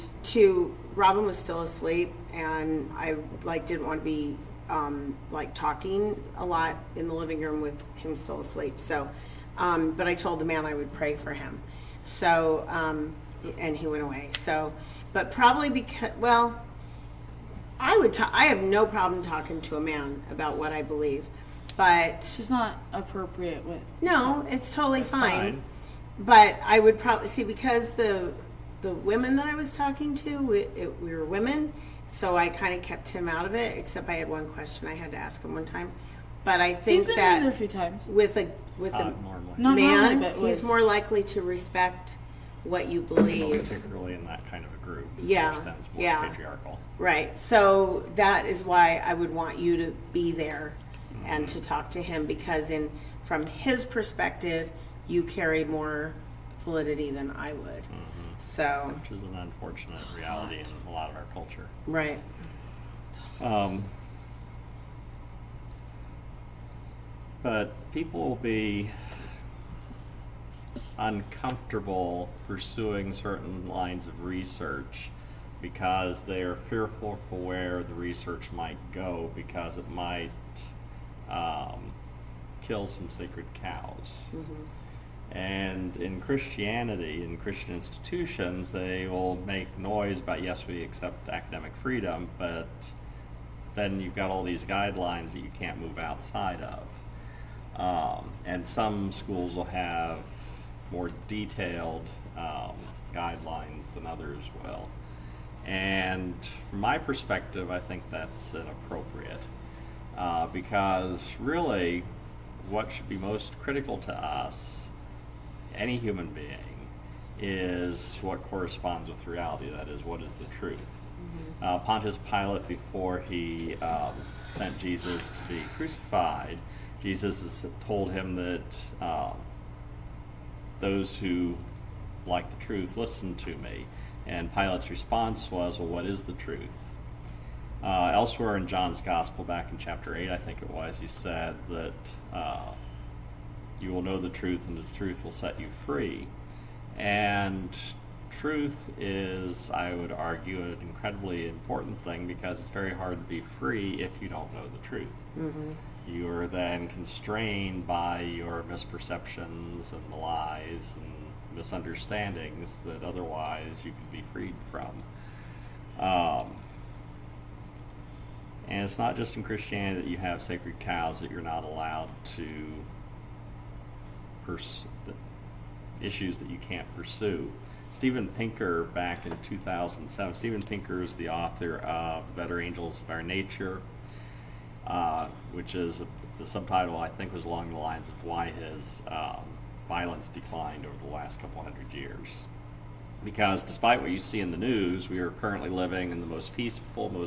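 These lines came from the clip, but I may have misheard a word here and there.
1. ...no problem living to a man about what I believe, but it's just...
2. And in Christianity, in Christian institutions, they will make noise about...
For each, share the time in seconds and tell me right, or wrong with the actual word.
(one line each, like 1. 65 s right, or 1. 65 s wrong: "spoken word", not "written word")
1. 18 s wrong: "talking", not "living"
2. 85 s right.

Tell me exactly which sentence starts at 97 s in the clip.
Um, and some schools will have more detailed um, guidelines than others will.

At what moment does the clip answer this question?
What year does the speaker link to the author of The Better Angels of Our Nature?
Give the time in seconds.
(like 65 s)
179 s.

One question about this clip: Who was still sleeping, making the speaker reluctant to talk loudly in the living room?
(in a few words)
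Robin.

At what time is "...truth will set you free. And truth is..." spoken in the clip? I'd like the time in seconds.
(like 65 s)
144 s.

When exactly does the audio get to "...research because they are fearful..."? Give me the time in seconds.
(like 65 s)
74 s.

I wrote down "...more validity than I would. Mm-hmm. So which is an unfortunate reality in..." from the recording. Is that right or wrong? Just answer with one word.
right.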